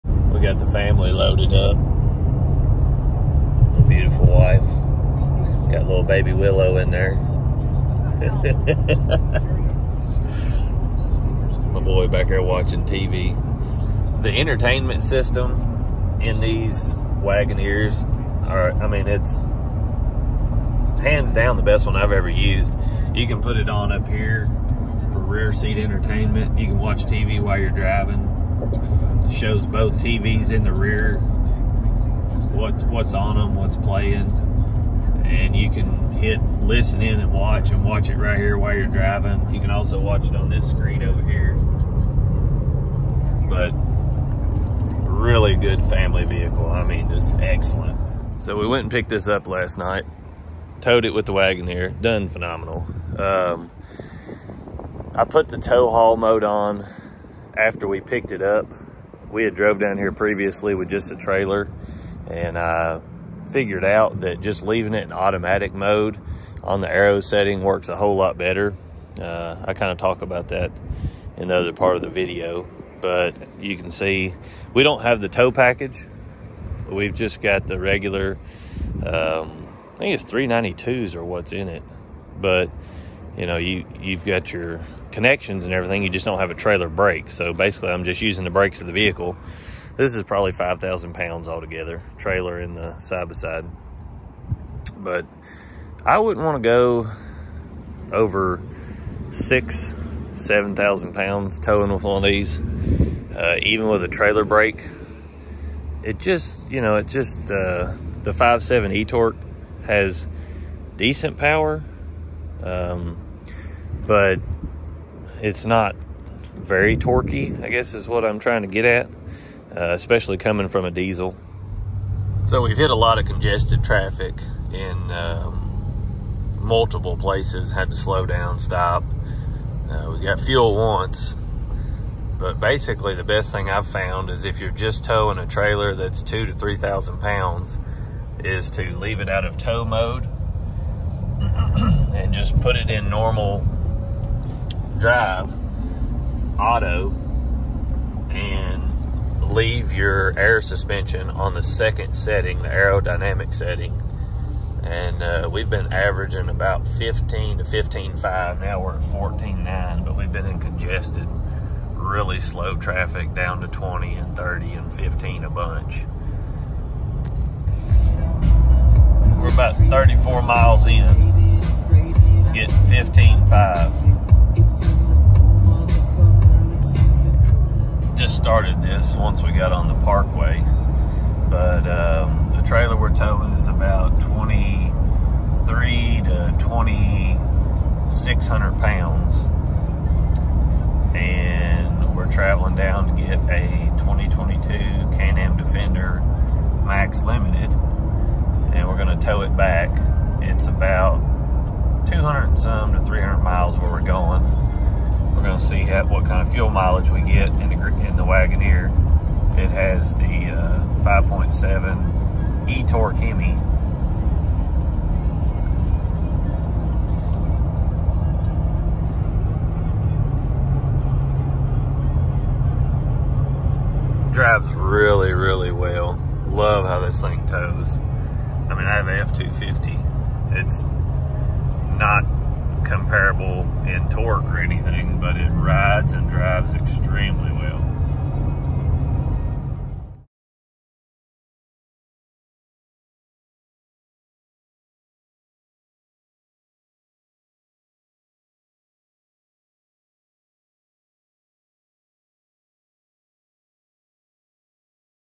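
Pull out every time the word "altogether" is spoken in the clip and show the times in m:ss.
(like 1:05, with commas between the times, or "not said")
1:31.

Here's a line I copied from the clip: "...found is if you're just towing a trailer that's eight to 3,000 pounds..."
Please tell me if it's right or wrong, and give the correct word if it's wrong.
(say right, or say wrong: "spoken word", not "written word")
wrong: "two", not "eight".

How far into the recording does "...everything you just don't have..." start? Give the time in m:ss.
1:25.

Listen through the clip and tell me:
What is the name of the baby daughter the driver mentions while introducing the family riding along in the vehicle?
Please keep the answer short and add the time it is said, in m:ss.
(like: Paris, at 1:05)
Willow, at 0:06.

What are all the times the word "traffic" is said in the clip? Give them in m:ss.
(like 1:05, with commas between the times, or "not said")
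2:03, 2:42.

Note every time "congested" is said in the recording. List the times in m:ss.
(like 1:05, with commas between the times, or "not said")
2:03, 2:40.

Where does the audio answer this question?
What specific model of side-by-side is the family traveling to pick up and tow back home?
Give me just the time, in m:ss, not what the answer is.
3:15.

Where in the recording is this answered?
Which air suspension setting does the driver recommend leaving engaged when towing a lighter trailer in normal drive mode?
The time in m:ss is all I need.
2:32.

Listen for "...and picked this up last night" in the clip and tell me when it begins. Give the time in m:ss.
0:48.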